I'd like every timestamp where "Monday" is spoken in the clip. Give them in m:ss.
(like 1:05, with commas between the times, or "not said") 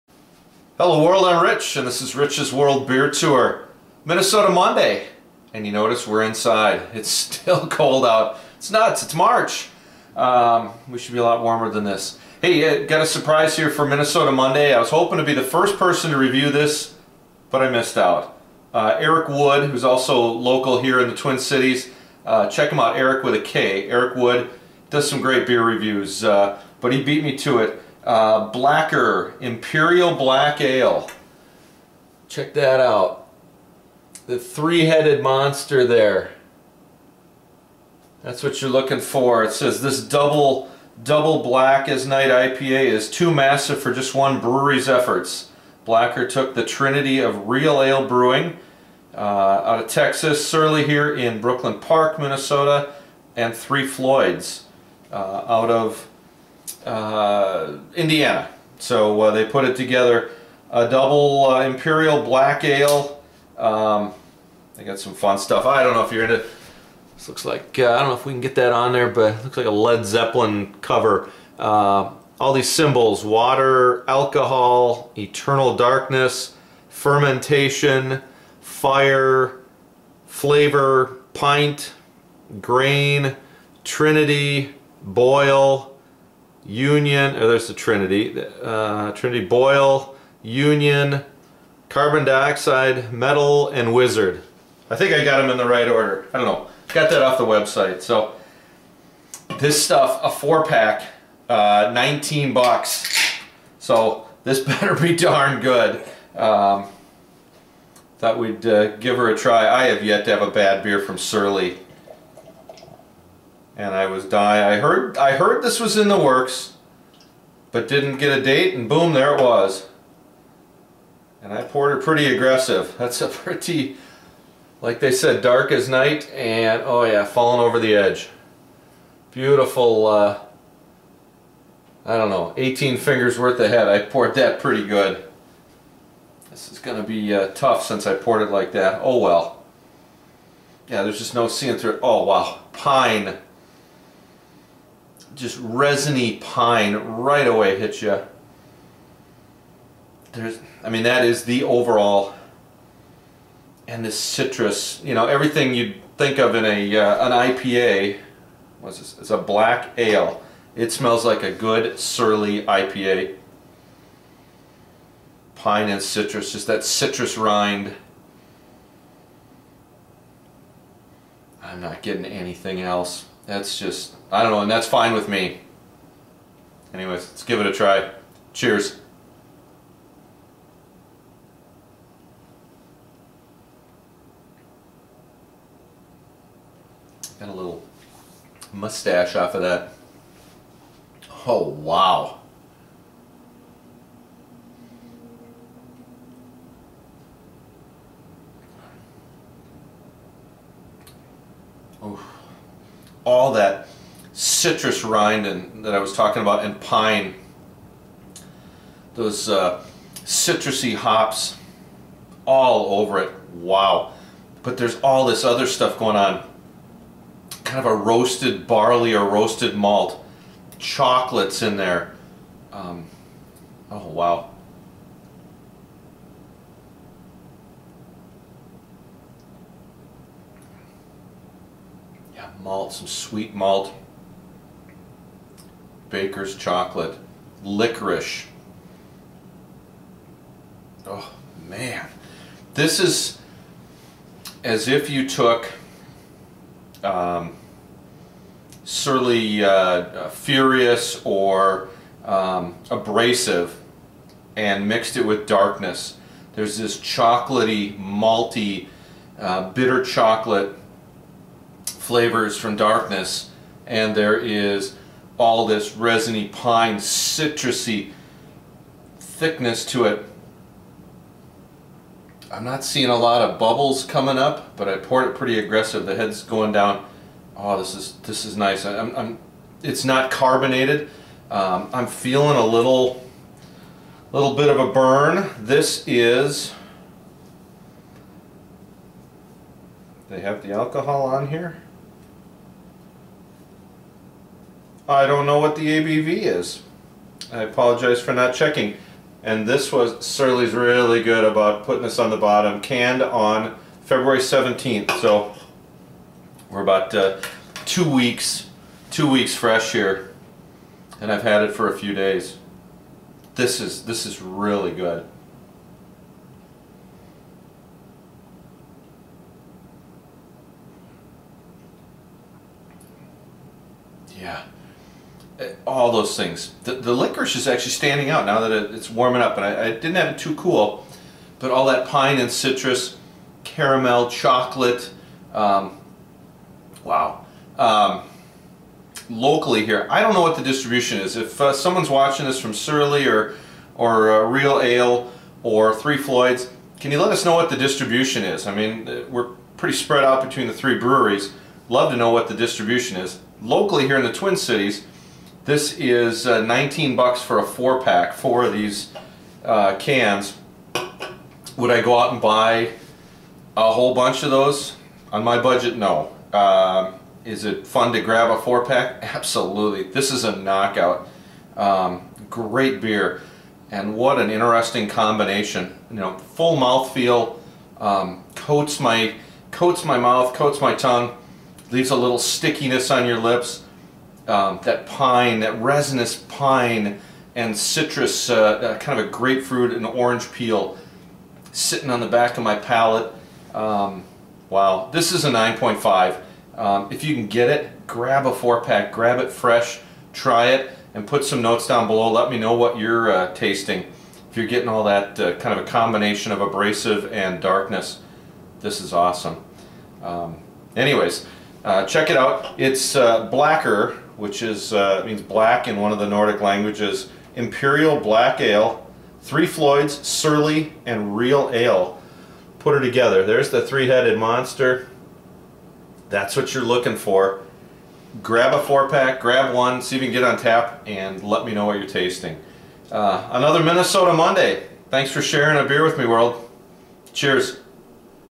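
0:04, 0:14, 7:14.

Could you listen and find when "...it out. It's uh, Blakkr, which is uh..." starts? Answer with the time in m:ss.
6:52.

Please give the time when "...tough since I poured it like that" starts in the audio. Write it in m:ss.
2:17.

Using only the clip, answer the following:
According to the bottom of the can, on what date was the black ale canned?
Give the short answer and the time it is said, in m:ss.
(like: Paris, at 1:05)
February 17th, at 5:04.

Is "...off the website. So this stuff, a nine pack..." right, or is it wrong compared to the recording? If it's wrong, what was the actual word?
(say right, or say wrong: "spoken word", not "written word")
wrong: "four", not "nine".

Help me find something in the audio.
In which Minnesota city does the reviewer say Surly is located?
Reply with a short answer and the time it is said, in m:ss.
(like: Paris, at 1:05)
Brooklyn Park, at 0:51.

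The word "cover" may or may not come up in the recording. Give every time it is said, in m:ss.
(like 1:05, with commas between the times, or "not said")
1:10.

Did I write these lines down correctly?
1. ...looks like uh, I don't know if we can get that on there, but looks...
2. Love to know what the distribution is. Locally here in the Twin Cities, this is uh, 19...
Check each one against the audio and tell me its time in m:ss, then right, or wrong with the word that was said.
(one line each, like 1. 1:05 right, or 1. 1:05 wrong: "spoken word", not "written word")
1. 1:07 right
2. 5:51 right.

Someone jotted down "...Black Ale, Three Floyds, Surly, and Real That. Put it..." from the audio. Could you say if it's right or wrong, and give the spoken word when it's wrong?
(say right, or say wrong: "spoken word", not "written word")
wrong: "Ale", not "That".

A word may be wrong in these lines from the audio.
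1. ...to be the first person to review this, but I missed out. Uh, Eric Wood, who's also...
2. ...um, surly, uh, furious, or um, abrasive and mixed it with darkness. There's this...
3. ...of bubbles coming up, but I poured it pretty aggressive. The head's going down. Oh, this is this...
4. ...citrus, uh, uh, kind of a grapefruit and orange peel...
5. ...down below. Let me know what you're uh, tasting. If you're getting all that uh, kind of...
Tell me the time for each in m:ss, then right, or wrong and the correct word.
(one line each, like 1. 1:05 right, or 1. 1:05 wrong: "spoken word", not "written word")
1. 0:15 right
2. 4:07 right
3. 4:33 right
4. 6:27 right
5. 6:41 right.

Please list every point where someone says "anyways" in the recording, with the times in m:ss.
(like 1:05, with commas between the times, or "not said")
2:56, 6:50.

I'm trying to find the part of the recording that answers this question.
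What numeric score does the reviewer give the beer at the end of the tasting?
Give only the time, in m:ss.
6:35.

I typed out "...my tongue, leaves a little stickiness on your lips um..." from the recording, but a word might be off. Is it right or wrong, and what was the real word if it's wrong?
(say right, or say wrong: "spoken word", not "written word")
right.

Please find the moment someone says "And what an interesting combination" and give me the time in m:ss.
6:13.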